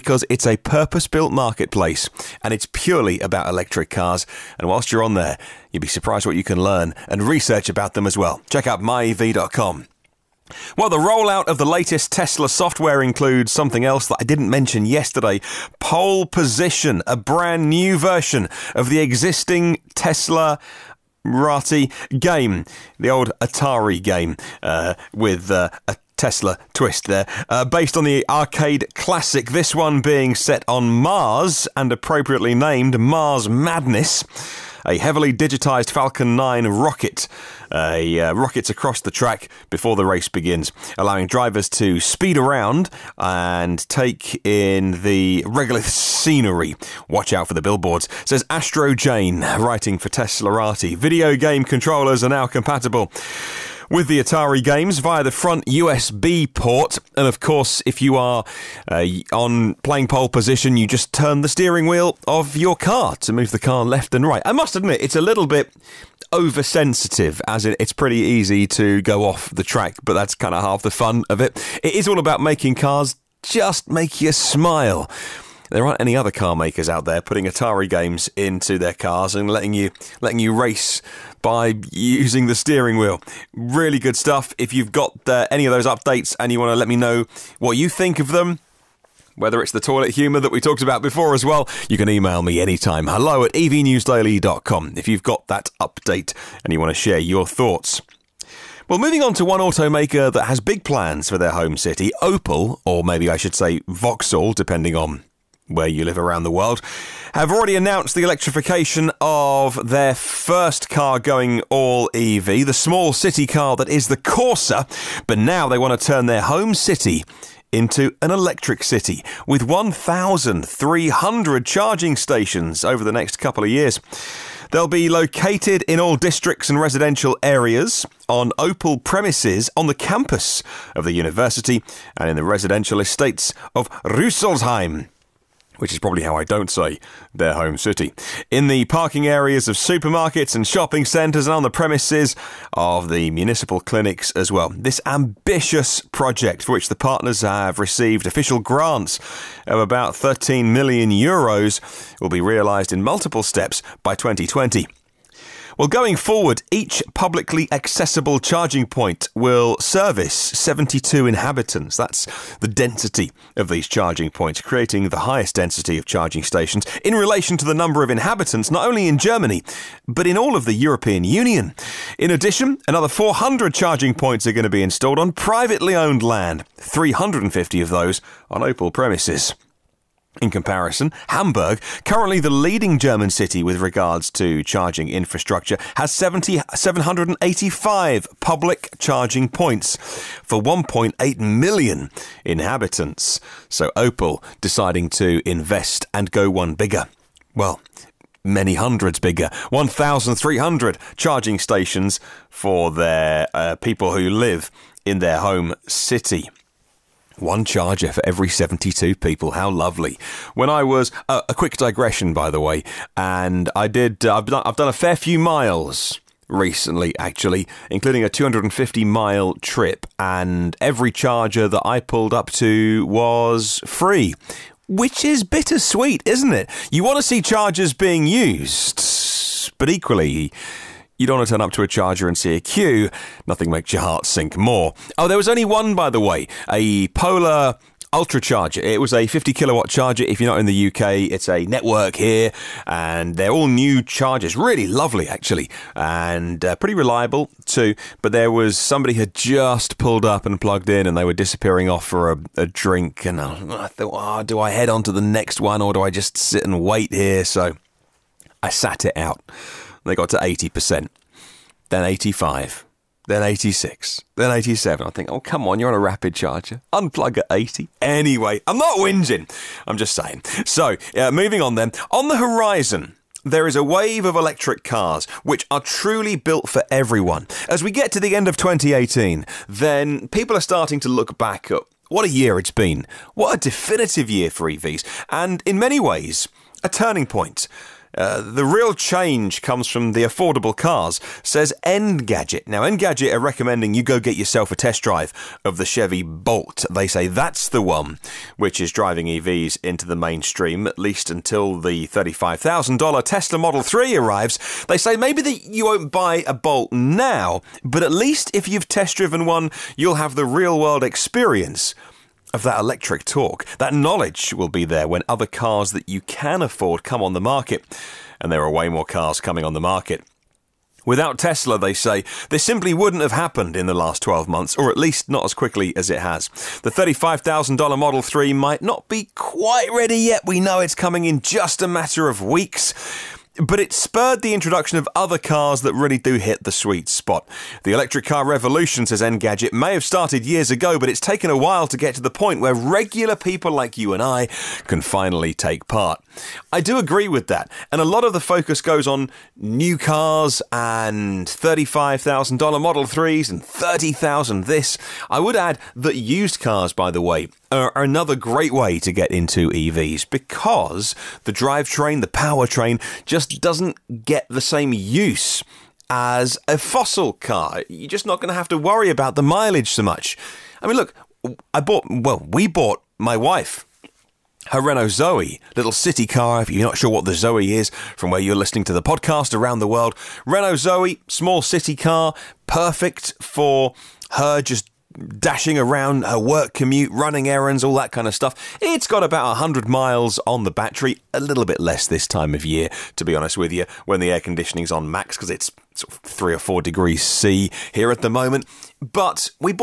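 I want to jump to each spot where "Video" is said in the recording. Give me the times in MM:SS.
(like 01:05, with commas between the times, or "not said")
00:50.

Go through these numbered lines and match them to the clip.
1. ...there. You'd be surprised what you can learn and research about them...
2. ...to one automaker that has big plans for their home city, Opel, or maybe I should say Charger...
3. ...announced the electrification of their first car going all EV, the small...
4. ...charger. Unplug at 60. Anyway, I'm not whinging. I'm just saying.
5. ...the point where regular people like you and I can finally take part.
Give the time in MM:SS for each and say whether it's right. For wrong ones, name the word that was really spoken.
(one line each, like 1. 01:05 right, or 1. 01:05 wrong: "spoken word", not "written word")
1. 00:05 right
2. 01:39 wrong: "Vauxhall", not "Charger"
3. 01:47 right
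4. 04:26 wrong: "80", not "60"
5. 05:42 right.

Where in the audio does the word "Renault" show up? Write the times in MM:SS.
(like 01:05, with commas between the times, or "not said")
06:14, 06:20.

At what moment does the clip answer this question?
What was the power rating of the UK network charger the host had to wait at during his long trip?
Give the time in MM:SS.
03:59.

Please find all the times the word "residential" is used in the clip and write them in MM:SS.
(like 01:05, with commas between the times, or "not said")
02:06, 02:12.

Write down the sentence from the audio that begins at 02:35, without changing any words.
Well, going forward, each publicly accessible charging point will service 72 inhabitants.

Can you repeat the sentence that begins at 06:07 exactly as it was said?
You're just not going to have to worry about the mileage so much.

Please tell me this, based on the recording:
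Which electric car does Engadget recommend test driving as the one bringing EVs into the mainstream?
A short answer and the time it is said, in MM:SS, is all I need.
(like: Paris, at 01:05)
Chevy Bolt, at 04:55.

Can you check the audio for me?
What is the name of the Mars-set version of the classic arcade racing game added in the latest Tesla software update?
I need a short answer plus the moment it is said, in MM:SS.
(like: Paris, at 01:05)
Mars Madness, at 00:32.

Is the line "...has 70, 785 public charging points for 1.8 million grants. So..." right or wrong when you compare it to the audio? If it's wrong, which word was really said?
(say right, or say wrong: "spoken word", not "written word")
wrong: "inhabitants", not "grants".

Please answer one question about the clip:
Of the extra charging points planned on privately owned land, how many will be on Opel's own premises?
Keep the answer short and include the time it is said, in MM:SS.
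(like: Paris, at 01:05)
350, at 02:56.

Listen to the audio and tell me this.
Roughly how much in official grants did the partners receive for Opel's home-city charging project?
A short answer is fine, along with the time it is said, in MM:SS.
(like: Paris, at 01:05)
13 million euros, at 02:30.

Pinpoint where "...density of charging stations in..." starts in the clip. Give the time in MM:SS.
02:45.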